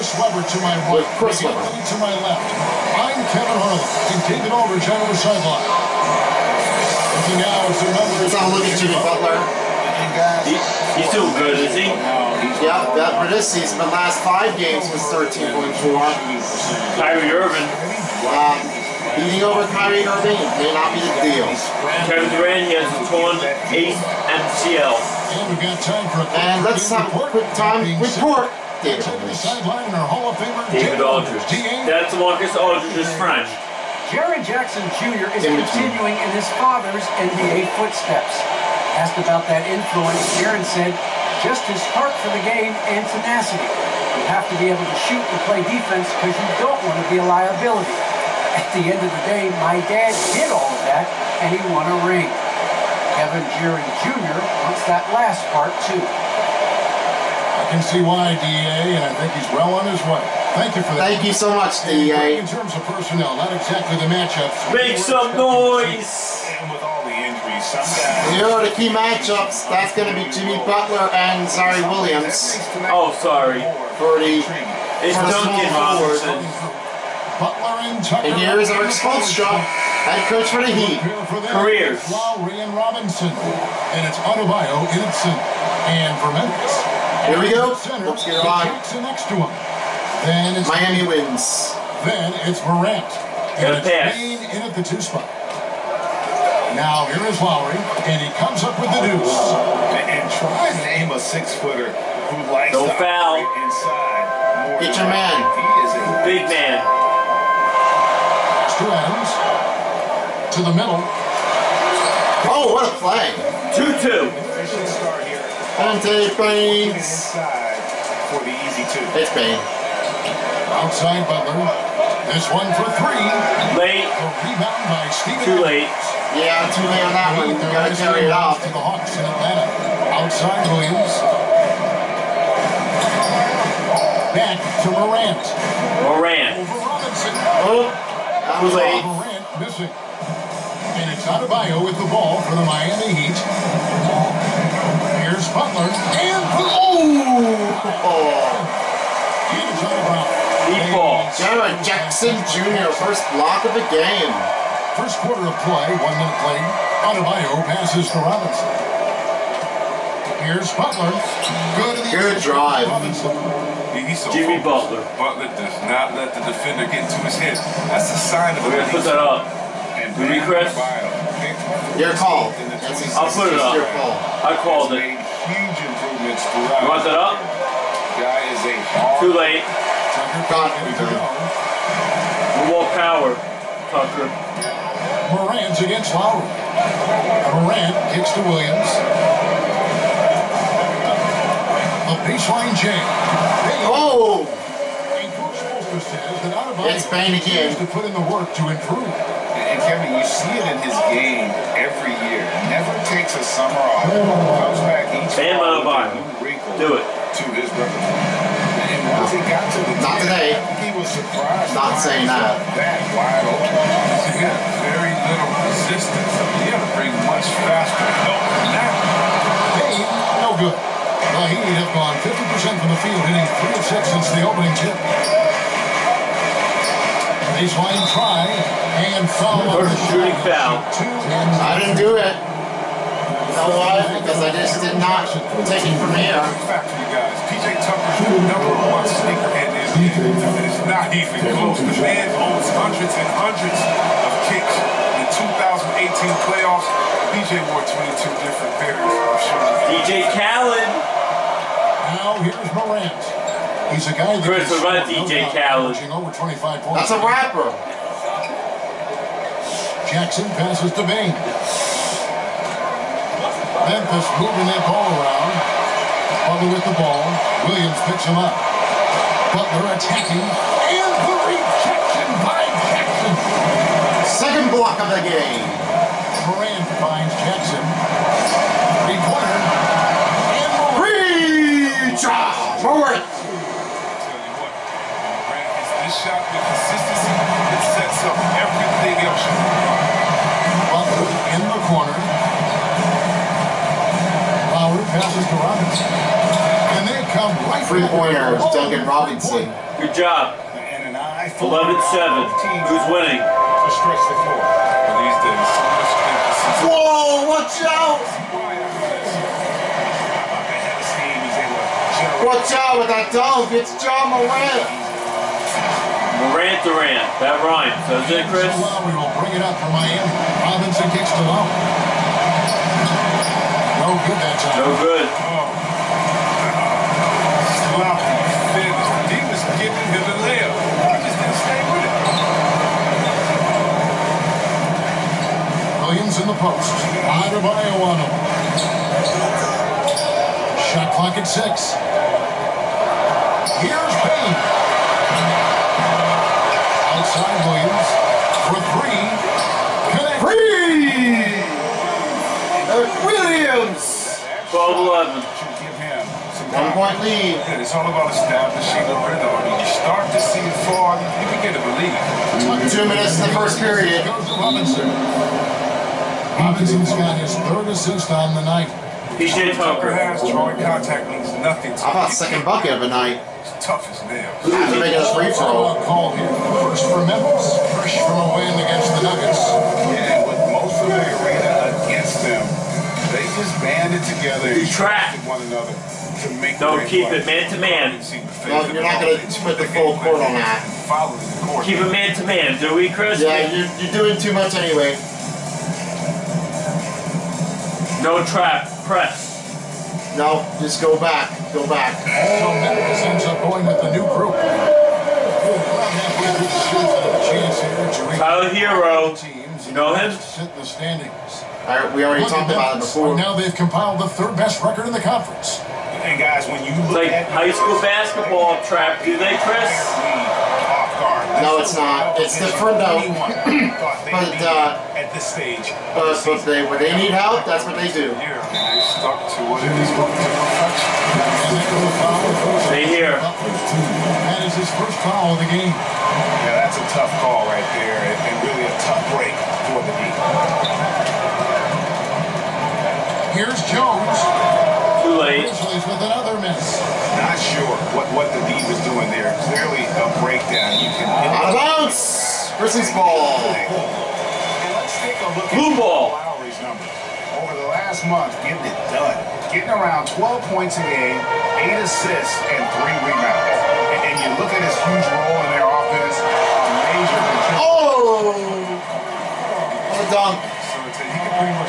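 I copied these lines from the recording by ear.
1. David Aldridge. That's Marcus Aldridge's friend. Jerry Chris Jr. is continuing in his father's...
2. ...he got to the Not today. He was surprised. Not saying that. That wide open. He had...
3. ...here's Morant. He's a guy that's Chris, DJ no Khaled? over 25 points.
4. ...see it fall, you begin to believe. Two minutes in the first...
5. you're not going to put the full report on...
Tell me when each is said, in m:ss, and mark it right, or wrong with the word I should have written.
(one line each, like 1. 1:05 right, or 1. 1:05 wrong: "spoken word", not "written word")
1. 0:28 wrong: "Jackson", not "Chris"
2. 3:29 right
3. 4:12 right
4. 6:00 right
5. 6:28 wrong: "court", not "report".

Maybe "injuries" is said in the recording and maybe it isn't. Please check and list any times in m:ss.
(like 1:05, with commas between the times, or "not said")
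1:07.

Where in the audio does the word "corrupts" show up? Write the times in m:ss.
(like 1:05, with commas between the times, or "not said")
not said.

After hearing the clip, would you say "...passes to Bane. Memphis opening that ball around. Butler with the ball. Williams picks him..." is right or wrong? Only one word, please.
wrong.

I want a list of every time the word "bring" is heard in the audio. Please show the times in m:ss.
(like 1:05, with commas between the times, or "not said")
3:36, 5:19.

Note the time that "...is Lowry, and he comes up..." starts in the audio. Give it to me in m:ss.
1:37.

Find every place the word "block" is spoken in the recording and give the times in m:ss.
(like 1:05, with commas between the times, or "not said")
2:33, 4:34.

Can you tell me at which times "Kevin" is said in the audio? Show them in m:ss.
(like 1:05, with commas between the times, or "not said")
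0:03, 0:22, 0:53, 3:19.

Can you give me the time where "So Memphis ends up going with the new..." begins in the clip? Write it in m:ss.
6:42.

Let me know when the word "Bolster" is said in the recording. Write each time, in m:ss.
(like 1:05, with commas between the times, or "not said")
3:15.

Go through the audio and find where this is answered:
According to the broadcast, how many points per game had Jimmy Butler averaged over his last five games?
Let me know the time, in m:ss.
0:15.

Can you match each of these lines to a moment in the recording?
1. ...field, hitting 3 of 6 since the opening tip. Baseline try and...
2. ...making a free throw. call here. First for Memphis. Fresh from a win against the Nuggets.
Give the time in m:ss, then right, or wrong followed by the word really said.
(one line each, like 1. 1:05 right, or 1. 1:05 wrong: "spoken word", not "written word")
1. 3:43 right
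2. 6:15 right.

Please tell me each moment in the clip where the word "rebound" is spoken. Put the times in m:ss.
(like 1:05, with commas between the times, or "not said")
2:04, 7:43.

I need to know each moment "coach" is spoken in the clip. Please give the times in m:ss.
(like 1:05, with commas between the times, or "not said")
1:20, 3:15.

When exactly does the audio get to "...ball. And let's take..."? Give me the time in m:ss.
7:33.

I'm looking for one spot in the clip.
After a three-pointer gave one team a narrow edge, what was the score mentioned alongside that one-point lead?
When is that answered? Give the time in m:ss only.
5:54.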